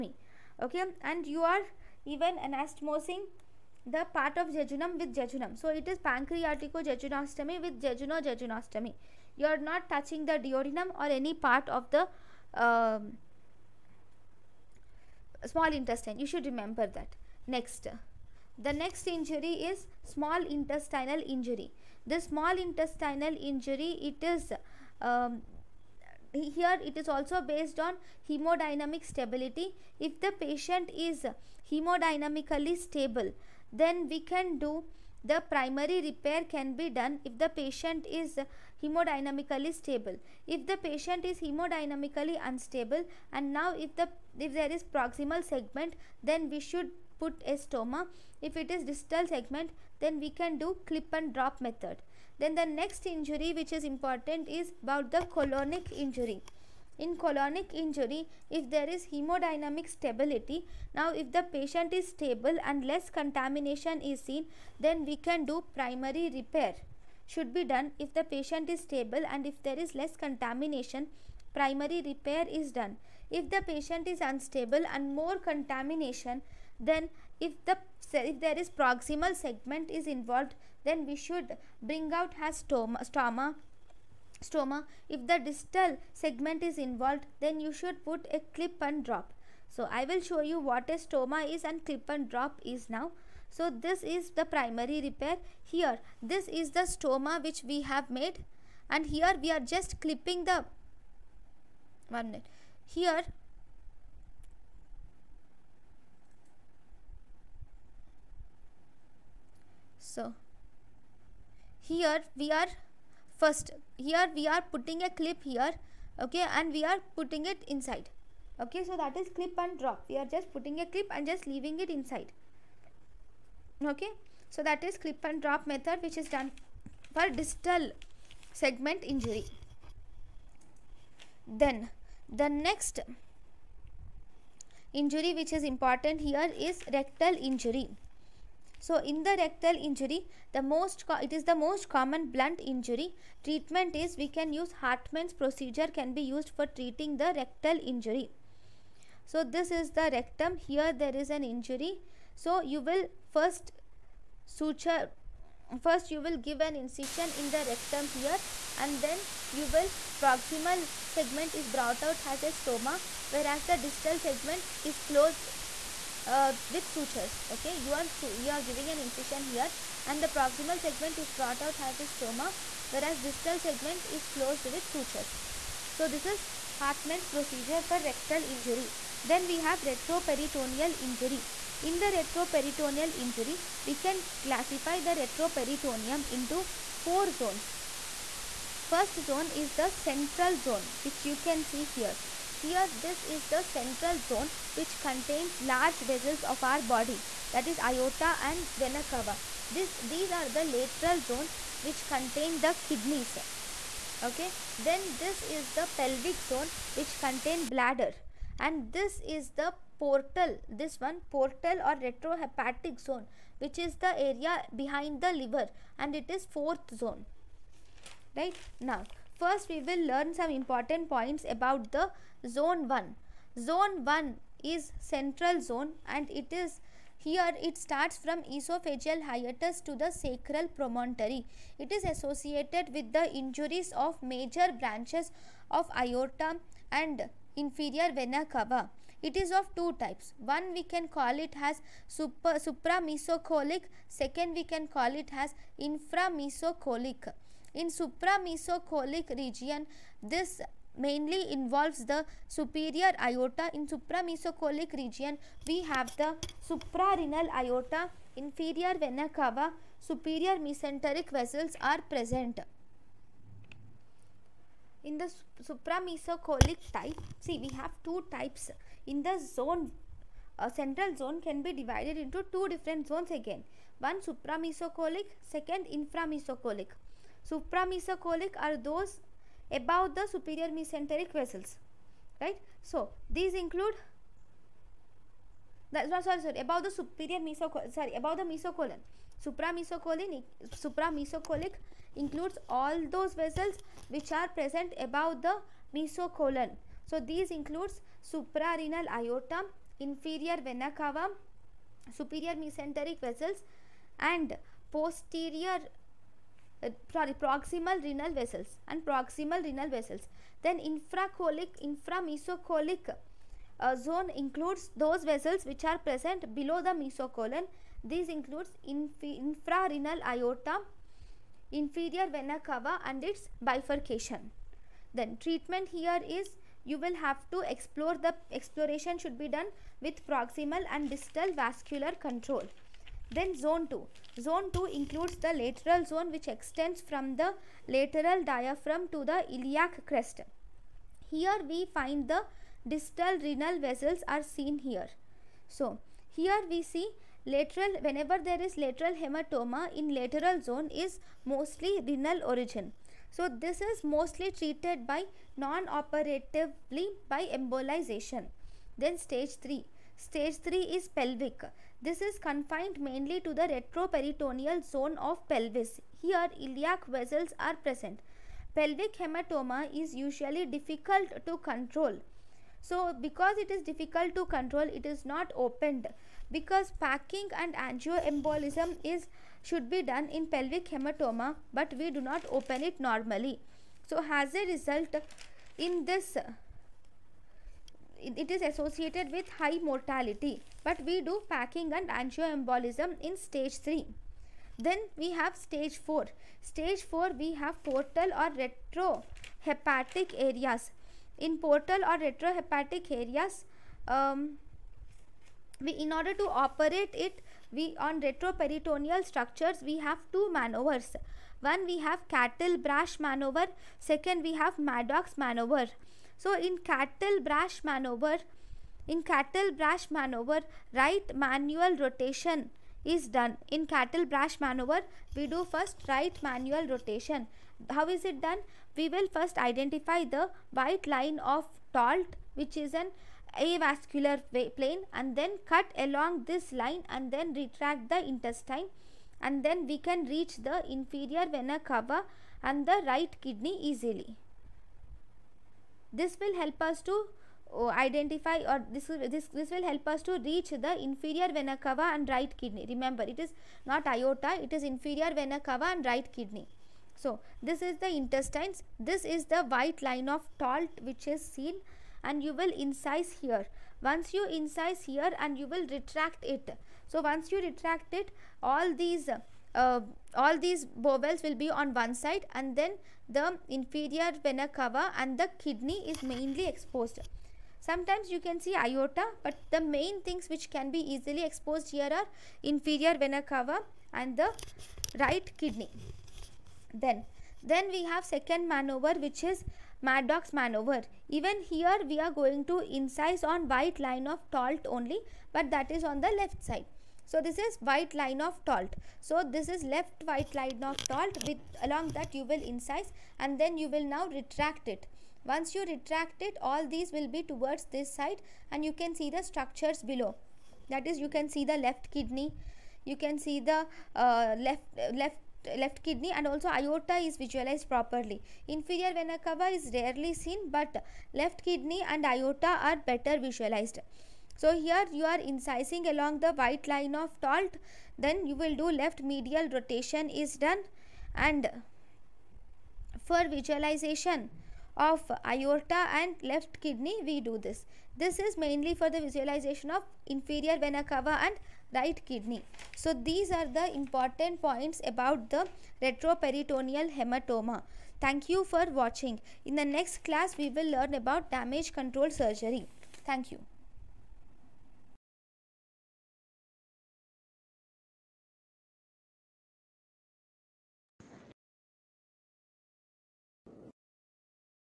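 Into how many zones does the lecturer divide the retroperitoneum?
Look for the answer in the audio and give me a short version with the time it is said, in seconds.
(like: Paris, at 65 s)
4, at 186 s.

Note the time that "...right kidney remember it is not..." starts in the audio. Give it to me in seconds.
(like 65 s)
452 s.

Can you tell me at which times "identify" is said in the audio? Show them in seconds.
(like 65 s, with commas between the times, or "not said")
429 s, 447 s.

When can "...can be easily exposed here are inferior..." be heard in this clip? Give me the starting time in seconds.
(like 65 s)
480 s.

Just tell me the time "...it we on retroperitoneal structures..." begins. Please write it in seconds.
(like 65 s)
407 s.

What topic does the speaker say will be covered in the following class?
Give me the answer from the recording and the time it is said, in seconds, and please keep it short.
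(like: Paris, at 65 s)
Damage control surgery, at 551 s.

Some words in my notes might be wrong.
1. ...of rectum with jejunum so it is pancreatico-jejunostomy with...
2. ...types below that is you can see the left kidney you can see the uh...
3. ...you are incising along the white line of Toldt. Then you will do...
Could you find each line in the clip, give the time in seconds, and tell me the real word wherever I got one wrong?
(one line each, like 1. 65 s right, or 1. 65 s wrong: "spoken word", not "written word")
1. 4 s wrong: "jejunum", not "rectum"
2. 509 s wrong: "structures", not "types"
3. 525 s right.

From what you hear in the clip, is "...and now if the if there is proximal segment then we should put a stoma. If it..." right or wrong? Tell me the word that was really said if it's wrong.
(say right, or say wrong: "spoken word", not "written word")
right.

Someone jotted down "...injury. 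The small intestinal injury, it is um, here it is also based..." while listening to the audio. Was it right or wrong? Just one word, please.
right.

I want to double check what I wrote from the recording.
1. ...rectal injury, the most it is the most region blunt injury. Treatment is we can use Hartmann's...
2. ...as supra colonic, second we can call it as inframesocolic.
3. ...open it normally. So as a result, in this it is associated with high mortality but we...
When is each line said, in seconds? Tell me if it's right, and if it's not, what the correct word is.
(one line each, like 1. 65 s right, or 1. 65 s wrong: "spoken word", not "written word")
1. 139 s wrong: "common", not "region"
2. 241 s wrong: "supramesocolic", not "colonic"
3. 382 s right.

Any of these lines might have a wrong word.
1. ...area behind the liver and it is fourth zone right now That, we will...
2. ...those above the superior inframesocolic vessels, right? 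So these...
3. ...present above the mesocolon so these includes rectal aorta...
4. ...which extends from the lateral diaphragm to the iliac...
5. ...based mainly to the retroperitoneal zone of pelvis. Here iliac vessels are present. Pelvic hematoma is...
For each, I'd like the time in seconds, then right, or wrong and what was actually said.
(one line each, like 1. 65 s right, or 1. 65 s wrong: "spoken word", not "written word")
1. 214 s wrong: "First", not "That"
2. 278 s wrong: "mesenteric", not "inframesocolic"
3. 294 s wrong: "suprarenal", not "rectal"
4. 336 s right
5. 362 s wrong: "confined", not "based".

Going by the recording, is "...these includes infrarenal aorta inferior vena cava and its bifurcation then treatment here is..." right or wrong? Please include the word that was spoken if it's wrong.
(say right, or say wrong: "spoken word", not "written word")
right.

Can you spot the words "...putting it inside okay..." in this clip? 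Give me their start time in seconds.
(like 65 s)
117 s.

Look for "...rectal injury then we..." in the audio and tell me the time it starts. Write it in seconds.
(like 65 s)
178 s.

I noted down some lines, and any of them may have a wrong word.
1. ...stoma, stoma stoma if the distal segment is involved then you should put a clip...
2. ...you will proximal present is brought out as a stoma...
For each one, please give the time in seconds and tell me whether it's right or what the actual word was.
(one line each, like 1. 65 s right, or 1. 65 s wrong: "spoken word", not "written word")
1. 82 s right
2. 159 s wrong: "segment", not "present".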